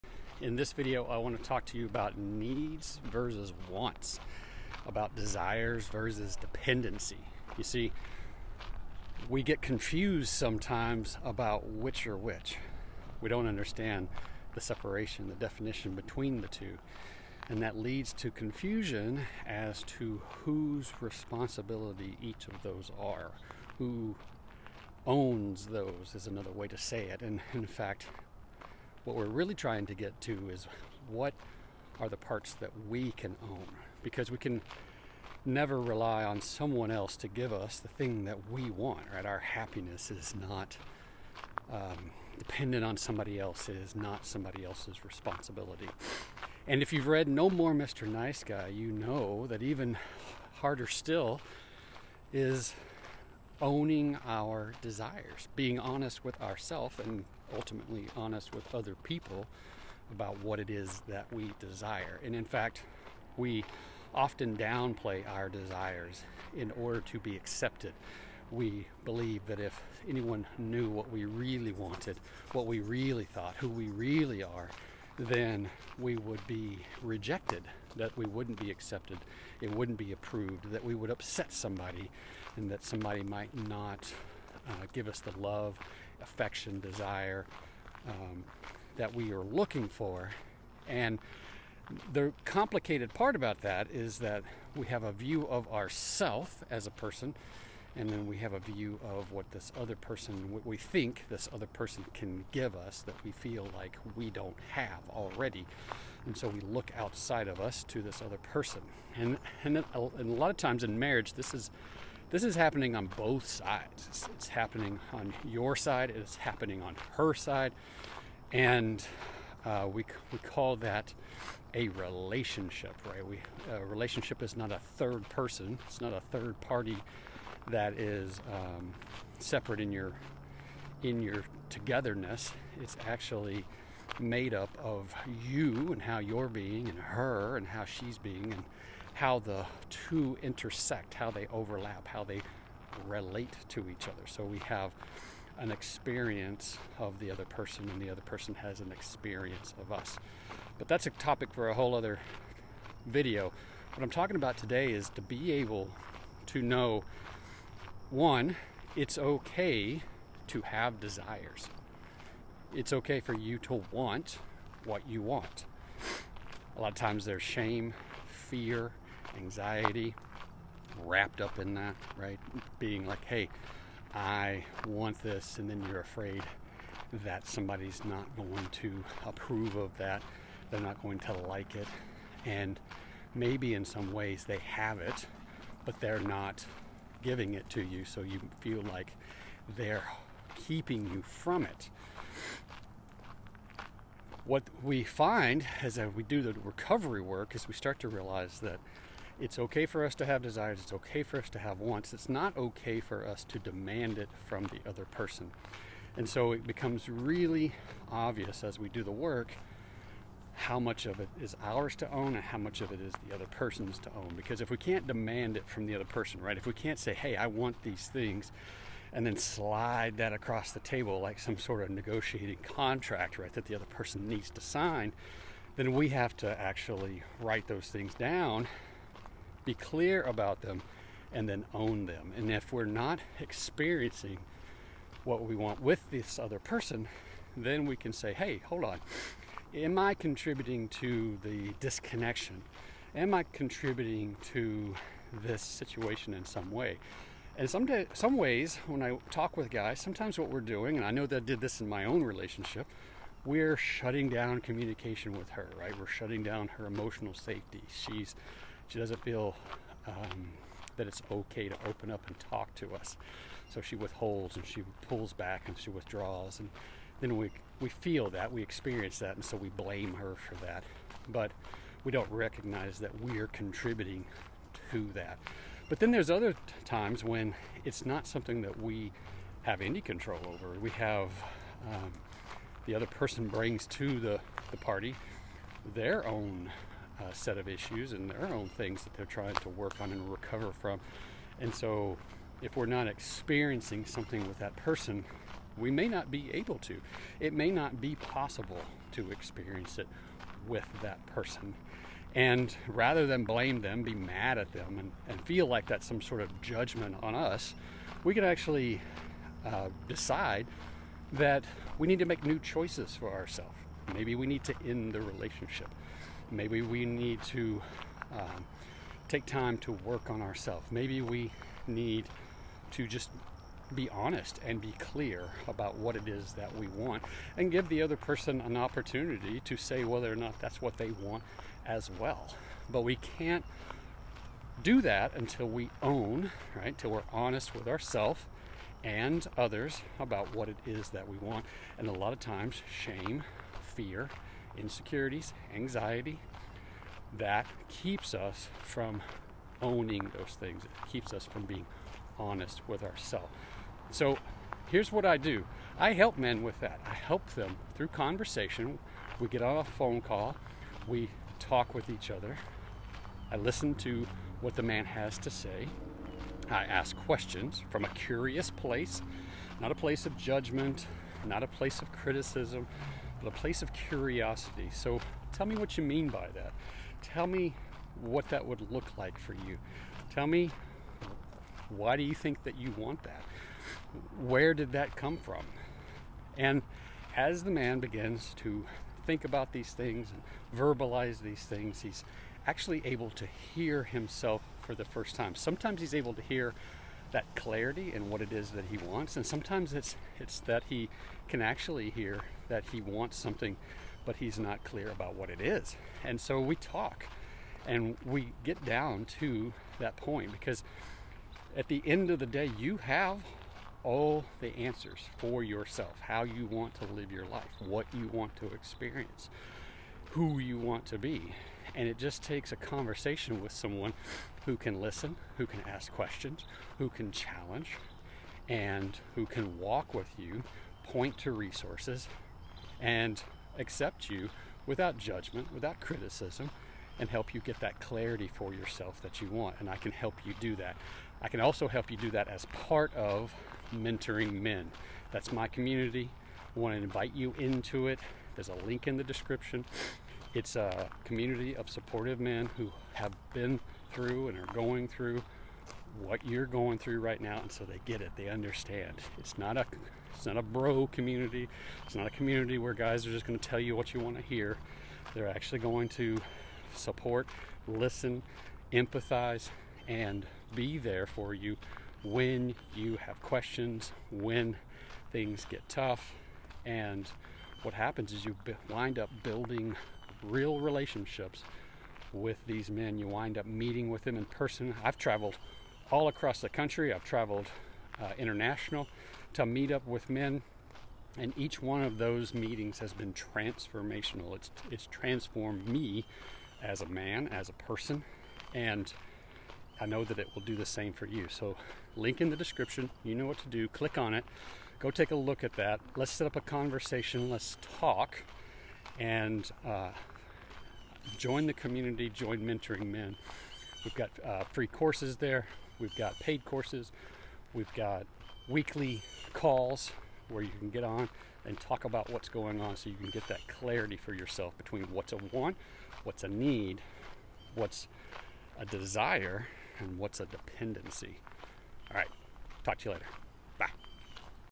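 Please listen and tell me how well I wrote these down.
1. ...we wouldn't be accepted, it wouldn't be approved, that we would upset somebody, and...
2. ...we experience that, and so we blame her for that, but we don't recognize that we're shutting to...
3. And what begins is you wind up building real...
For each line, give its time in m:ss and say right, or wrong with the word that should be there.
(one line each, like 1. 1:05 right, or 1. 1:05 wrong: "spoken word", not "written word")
1. 1:18 right
2. 4:28 wrong: "contributing", not "shutting"
3. 7:56 wrong: "happens", not "begins".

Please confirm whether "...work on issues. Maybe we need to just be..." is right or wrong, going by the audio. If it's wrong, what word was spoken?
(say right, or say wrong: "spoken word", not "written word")
wrong: "ourselves", not "issues".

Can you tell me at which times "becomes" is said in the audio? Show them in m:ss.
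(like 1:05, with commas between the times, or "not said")
3:26.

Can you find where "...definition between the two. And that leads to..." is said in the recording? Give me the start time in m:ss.
0:15.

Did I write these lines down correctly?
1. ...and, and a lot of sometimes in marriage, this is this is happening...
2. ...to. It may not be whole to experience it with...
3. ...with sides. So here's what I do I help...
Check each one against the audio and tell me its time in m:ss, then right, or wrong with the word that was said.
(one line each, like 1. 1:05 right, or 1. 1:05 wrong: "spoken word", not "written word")
1. 1:49 wrong: "times", not "sometimes"
2. 4:56 wrong: "possible", not "whole"
3. 5:52 wrong: "ourselves", not "sides".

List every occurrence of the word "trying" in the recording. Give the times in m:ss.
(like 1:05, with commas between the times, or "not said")
0:29, 4:49.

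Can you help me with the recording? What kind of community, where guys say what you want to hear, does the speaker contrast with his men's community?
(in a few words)
A bro community.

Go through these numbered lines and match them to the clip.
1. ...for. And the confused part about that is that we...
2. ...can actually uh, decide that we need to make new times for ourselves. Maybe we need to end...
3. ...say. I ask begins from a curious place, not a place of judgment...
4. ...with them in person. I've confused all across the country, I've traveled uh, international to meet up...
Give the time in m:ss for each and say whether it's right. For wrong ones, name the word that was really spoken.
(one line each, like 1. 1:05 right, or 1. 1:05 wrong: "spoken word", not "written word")
1. 1:29 wrong: "complicated", not "confused"
2. 5:08 wrong: "choices", not "times"
3. 6:05 wrong: "questions", not "begins"
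4. 8:04 wrong: "traveled", not "confused".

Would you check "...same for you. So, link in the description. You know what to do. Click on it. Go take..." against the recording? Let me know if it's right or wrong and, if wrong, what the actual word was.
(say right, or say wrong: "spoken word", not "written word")
right.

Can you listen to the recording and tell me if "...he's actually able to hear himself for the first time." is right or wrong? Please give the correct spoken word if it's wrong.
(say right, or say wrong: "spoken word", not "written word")
right.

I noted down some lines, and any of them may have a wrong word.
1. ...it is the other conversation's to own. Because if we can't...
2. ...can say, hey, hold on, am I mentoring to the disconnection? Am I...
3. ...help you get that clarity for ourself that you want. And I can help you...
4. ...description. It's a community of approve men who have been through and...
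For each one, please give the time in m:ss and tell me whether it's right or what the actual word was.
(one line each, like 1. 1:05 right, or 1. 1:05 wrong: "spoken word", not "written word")
1. 3:32 wrong: "person", not "conversation"
2. 3:57 wrong: "contributing", not "mentoring"
3. 7:17 wrong: "yourself", not "ourself"
4. 7:29 wrong: "supportive", not "approve".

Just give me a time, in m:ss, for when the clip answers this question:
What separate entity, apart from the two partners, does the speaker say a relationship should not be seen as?
2:04.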